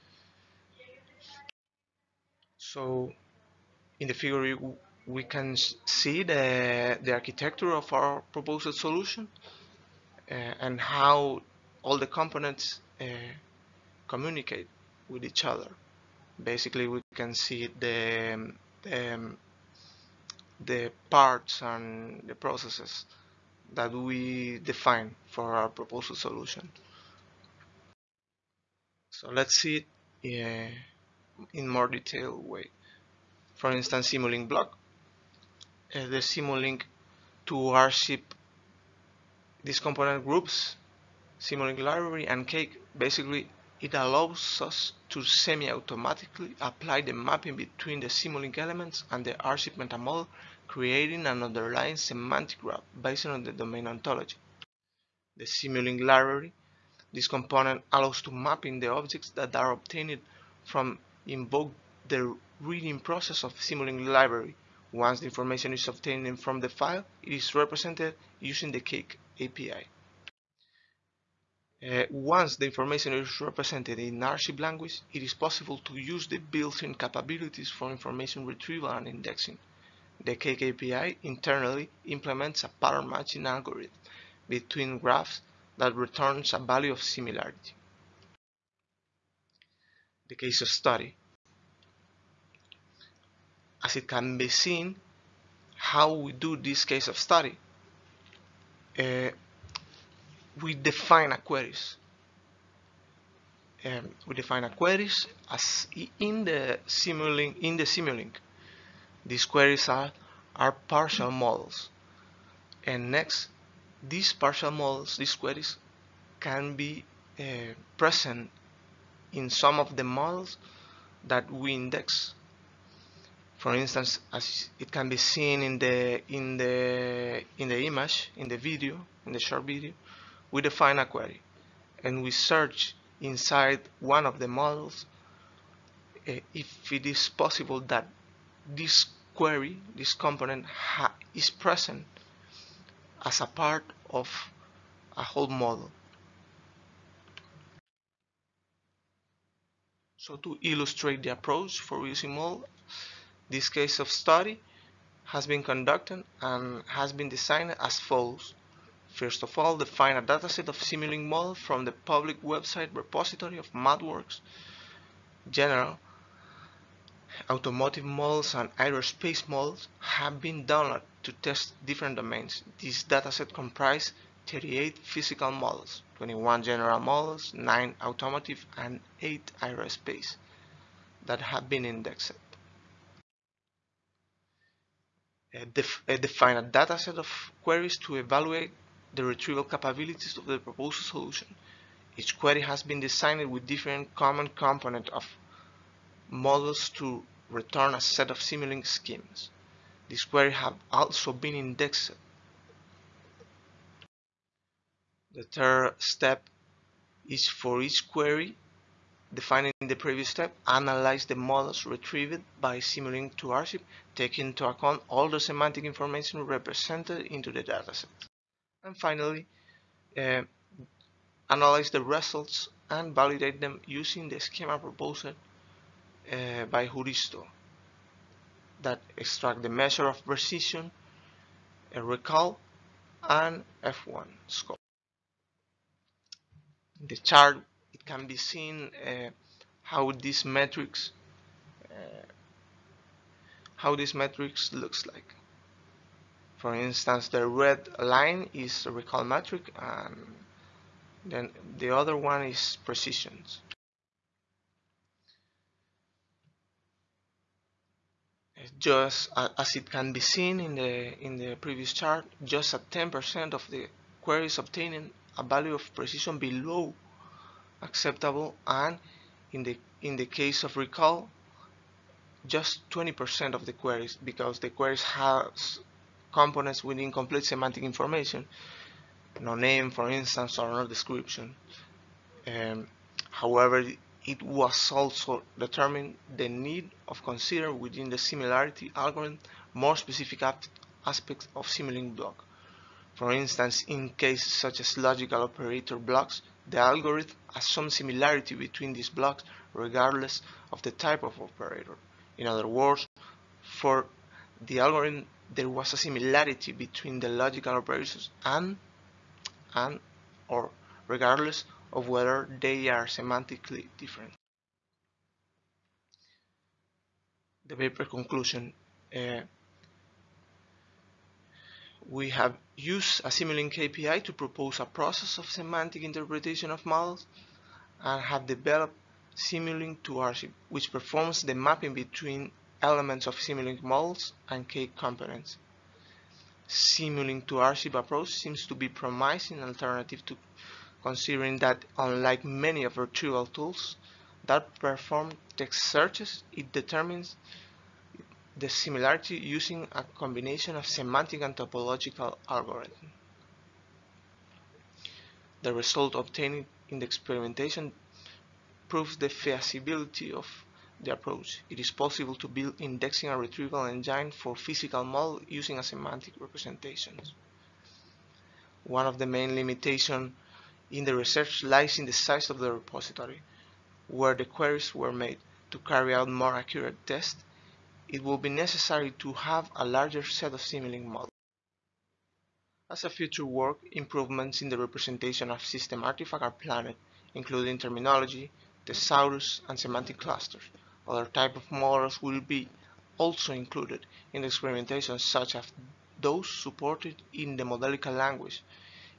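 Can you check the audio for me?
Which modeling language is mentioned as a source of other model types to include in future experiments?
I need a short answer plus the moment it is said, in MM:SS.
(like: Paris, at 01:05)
Modelica, at 06:37.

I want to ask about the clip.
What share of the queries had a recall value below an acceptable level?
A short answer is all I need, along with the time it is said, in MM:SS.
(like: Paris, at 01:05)
20%, at 04:32.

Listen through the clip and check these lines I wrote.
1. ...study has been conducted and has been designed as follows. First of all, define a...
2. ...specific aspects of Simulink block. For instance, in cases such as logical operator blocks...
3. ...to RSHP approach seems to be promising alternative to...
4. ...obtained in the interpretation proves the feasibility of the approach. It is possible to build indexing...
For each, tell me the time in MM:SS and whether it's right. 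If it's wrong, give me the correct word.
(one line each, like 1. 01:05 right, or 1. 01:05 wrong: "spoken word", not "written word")
1. 02:34 right
2. 04:49 right
3. 05:37 right
4. 05:56 wrong: "experimentation", not "interpretation".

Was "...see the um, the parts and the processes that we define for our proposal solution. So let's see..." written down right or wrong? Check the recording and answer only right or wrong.
right.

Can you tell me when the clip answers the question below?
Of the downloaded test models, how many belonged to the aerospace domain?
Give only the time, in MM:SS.
02:59.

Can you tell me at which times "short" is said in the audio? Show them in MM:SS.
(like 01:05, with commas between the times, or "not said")
02:09.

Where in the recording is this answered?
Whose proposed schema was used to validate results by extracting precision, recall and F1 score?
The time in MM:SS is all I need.
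03:46.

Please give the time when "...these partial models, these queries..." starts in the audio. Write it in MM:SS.
01:54.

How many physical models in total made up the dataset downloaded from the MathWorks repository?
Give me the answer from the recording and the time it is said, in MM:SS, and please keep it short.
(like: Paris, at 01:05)
38, at 02:54.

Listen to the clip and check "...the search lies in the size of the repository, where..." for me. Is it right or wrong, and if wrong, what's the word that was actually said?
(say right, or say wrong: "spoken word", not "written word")
wrong: "research", not "search".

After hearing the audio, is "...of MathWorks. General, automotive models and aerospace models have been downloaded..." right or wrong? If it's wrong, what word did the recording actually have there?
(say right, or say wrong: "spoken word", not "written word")
right.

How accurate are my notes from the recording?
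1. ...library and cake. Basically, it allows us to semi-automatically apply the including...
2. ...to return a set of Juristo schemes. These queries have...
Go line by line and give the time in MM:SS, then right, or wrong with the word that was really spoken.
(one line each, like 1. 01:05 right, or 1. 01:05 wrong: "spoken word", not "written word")
1. 00:41 wrong: "mapping", not "including"
2. 03:16 wrong: "Simulink", not "Juristo".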